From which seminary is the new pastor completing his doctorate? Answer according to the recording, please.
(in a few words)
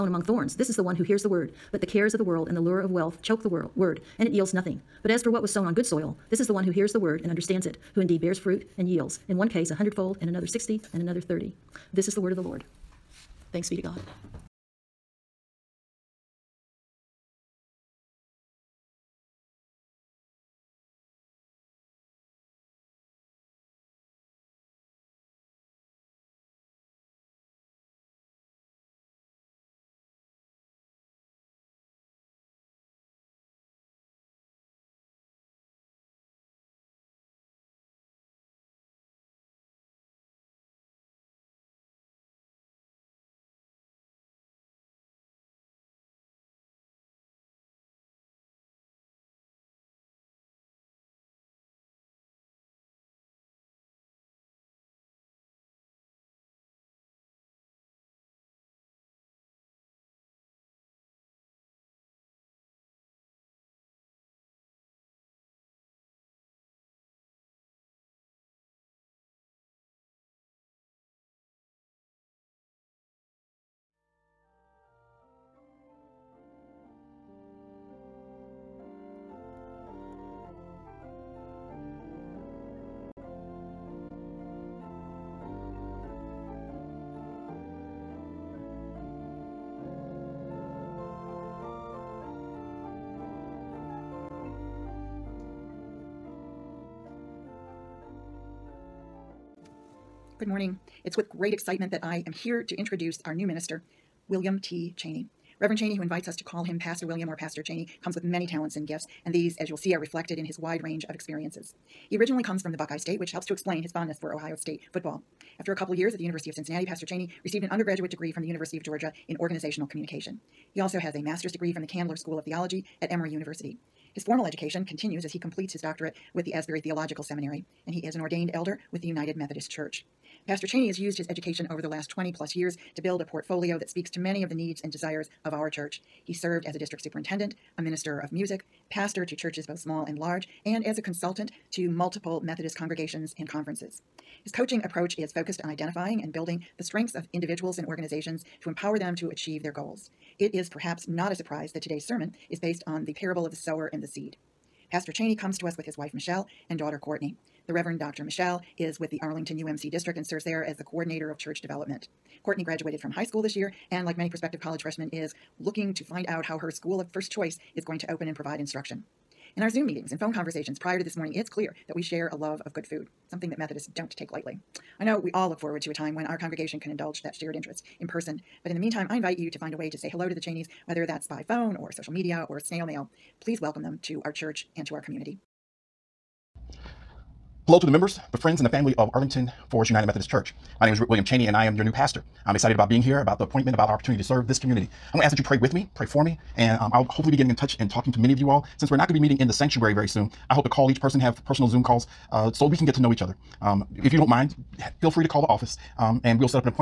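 Asbury Theological Seminary.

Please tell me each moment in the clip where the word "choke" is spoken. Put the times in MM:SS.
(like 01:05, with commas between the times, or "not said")
00:03.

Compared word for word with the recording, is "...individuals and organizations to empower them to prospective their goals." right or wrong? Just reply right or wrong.
wrong.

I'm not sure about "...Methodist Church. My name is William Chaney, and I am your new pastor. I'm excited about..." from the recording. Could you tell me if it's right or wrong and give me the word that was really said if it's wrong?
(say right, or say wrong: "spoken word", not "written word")
right.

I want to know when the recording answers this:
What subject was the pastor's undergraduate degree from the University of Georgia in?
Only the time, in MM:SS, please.
01:59.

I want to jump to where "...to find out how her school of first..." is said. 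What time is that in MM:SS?
02:45.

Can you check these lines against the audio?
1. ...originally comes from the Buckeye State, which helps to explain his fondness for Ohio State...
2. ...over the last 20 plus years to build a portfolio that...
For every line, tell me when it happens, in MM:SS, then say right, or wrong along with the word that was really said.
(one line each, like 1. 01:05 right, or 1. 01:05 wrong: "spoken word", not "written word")
1. 01:52 right
2. 02:11 right.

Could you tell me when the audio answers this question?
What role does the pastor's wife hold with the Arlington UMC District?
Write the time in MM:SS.
02:40.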